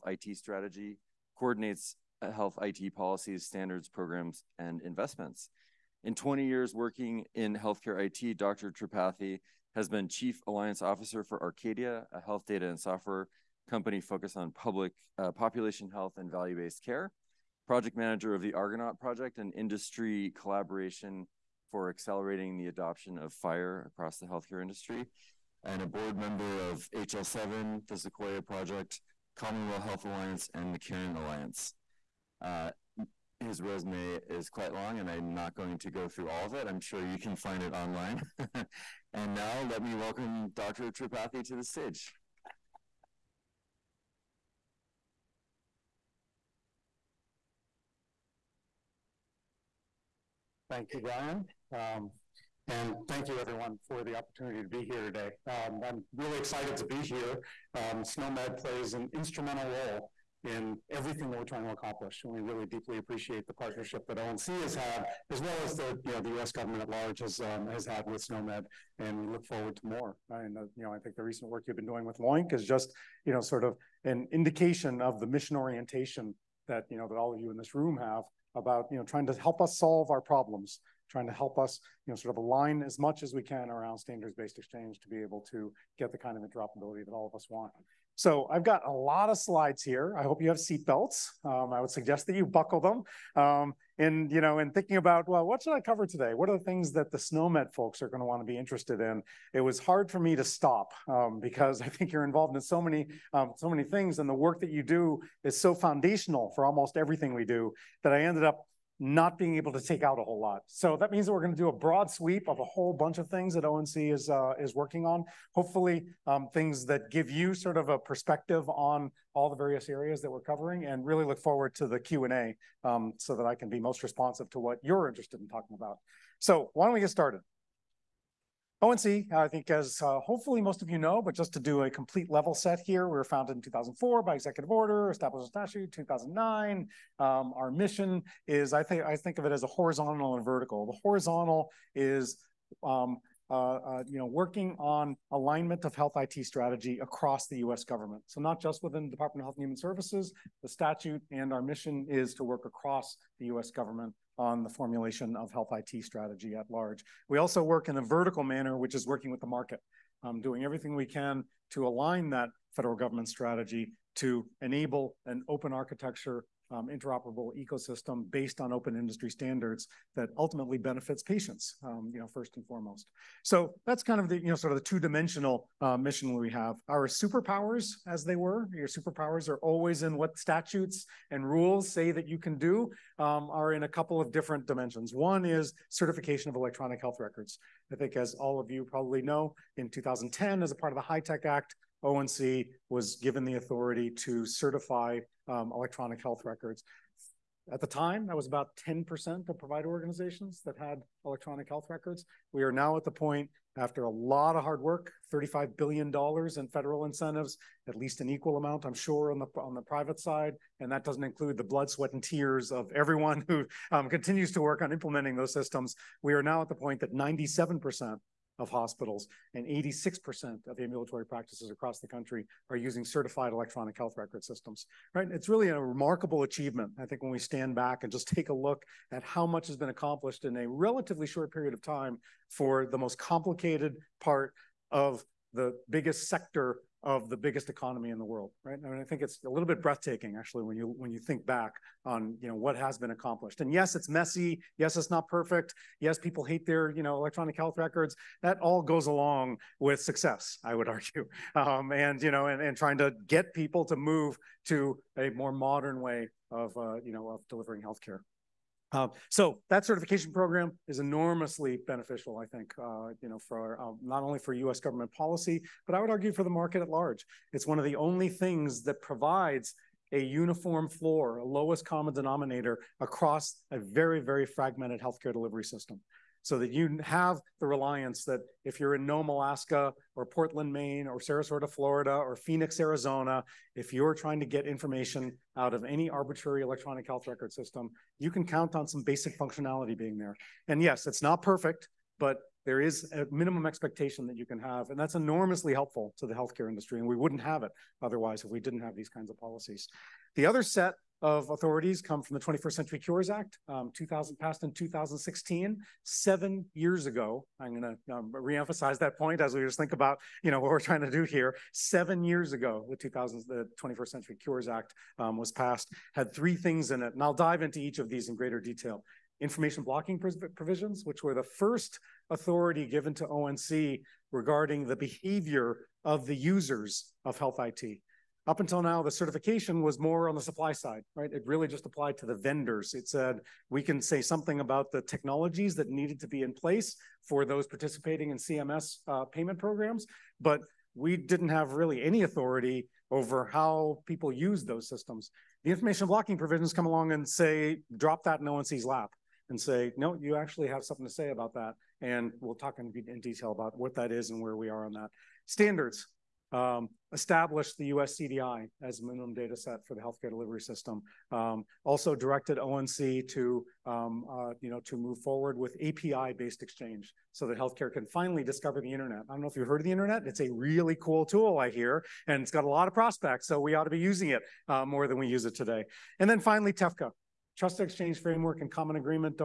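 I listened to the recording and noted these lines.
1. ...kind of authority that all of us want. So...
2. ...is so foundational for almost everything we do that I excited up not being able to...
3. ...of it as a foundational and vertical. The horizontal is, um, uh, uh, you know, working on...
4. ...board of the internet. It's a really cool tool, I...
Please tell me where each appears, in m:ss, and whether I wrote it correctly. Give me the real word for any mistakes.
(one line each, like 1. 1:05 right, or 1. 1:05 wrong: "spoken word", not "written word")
1. 1:26 wrong: "interoperability", not "authority"
2. 1:45 wrong: "ended", not "excited"
3. 2:19 wrong: "horizontal", not "foundational"
4. 6:09 wrong: "heard", not "board".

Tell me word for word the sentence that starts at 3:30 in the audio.
And that doesn't include the blood, sweat, and tears of everyone who um, continues to work on implementing those systems.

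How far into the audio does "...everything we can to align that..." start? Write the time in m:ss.
2:40.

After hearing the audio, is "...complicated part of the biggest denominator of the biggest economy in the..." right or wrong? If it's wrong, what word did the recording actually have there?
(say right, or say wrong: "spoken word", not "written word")
wrong: "sector", not "denominator".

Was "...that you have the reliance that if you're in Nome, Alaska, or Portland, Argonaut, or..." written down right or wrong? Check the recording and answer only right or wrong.
wrong.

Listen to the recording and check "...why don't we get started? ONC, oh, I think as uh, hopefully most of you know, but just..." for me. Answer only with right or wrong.
right.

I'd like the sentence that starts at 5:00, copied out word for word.
The other set of authorities come from the 21st Century Cures Act, um, 2000 passed in 2016, seven years ago.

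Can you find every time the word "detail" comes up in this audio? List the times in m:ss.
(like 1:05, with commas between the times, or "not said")
5:18, 5:53.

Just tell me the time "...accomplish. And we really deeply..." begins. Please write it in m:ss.
1:01.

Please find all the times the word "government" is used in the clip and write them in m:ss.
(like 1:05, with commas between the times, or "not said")
1:06, 2:27, 2:33, 2:42, 4:24.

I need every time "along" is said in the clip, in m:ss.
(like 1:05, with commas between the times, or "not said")
4:09, 5:46.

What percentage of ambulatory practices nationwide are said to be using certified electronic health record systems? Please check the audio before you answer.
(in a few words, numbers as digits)
86%.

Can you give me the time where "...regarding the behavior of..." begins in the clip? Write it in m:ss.
5:24.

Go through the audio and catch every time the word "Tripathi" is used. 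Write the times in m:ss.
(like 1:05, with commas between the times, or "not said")
0:08, 0:40.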